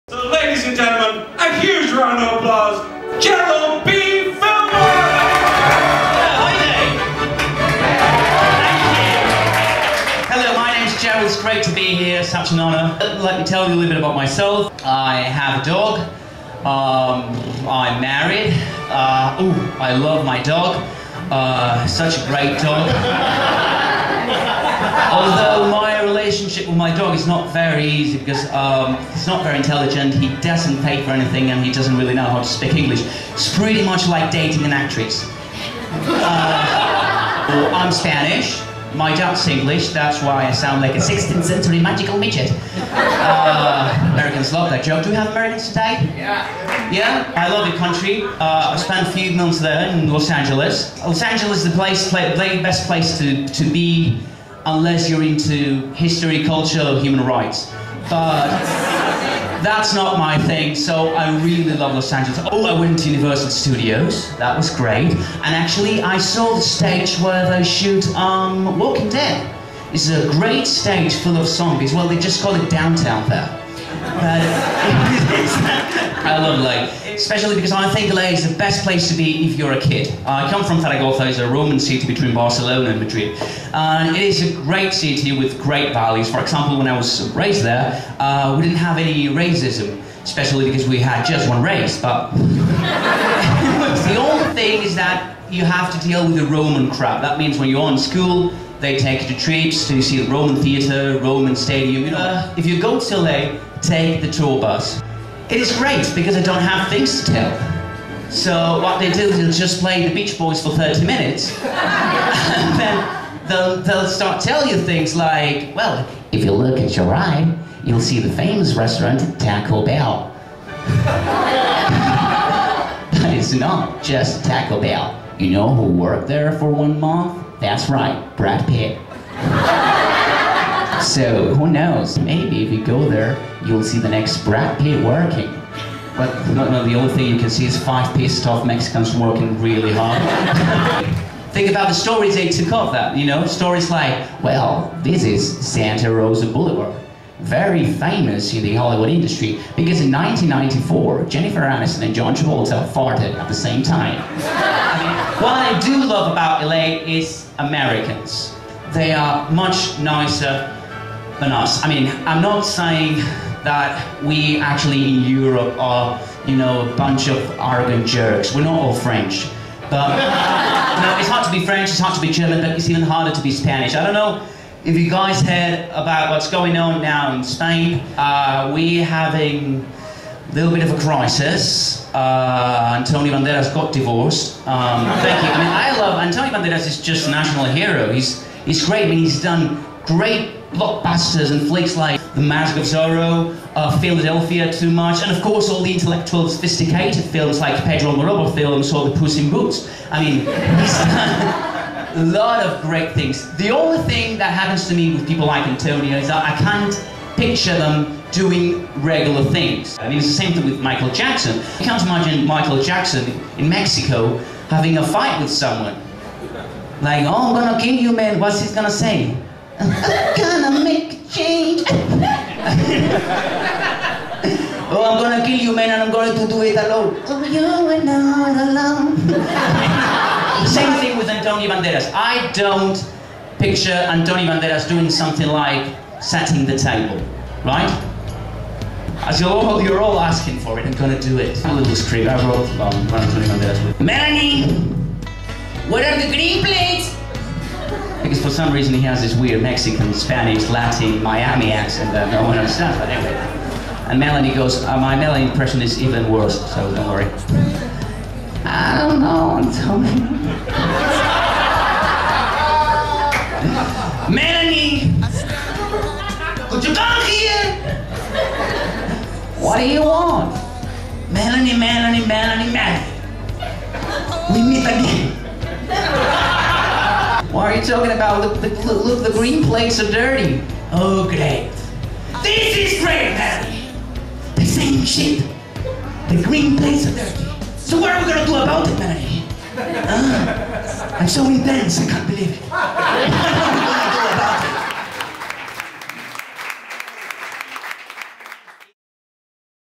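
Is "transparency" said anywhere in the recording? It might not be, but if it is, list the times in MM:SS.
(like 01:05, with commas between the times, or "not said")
not said.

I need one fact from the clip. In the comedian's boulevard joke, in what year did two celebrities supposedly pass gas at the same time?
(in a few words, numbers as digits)
1994.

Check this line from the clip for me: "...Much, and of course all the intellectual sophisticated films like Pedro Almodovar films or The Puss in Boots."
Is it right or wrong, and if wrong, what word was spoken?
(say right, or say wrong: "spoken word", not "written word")
right.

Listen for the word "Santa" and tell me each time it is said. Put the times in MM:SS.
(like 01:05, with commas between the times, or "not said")
02:25.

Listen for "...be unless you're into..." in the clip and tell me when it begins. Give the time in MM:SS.
00:53.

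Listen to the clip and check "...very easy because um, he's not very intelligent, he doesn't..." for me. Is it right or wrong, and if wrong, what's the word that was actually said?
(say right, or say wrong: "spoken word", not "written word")
right.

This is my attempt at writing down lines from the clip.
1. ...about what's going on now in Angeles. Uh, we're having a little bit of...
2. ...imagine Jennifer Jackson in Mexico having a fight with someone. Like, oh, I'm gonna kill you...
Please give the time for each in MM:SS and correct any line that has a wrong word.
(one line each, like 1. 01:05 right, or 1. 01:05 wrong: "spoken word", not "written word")
1. 02:55 wrong: "Spain", not "Angeles"
2. 03:32 wrong: "Michael", not "Jennifer".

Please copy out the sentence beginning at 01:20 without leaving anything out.
I come from Zaragoza, it's a Roman city between Barcelona and Madrid.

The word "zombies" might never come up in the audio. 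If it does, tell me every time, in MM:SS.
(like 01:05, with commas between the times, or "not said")
01:11.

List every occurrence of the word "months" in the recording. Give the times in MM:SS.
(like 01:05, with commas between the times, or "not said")
00:49, 02:06.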